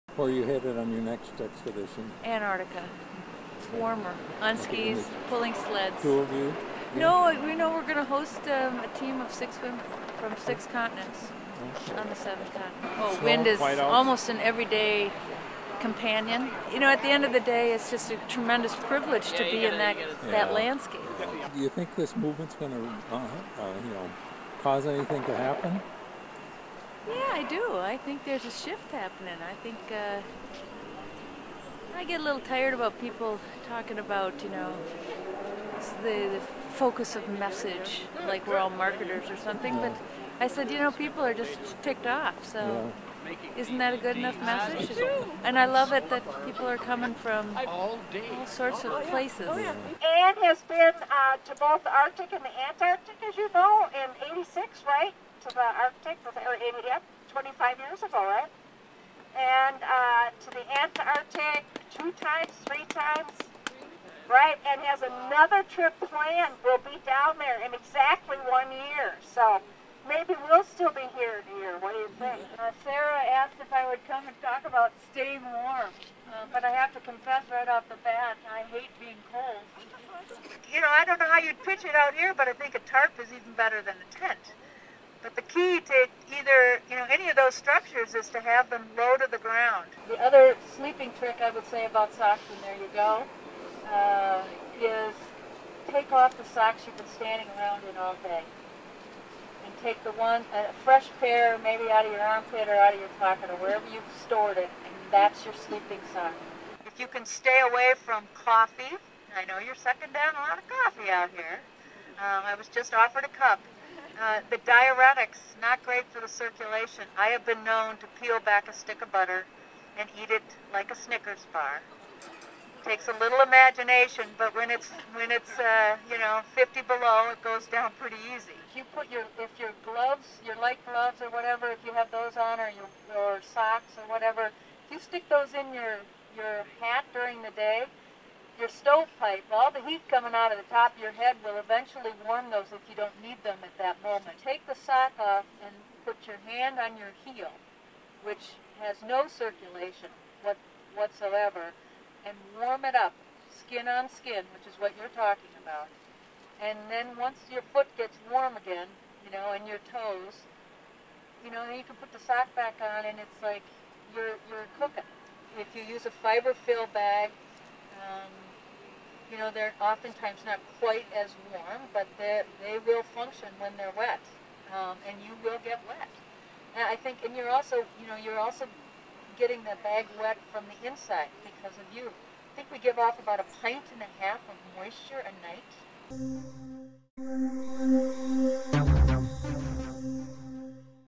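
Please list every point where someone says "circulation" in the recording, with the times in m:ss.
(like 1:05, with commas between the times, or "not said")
1:56, 2:29.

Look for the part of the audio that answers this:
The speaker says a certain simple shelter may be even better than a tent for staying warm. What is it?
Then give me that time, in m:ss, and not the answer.
1:22.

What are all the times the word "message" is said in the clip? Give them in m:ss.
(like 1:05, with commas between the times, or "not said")
0:37, 0:44.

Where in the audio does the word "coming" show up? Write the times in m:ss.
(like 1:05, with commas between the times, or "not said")
0:46, 2:20.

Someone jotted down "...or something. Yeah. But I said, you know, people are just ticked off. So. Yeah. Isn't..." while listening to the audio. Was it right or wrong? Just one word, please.
right.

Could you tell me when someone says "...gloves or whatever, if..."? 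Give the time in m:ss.
2:10.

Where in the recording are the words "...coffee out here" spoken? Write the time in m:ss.
1:50.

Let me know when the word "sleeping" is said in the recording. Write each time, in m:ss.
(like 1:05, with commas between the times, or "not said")
1:30, 1:45.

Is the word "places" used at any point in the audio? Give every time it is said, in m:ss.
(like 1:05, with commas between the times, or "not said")
0:49.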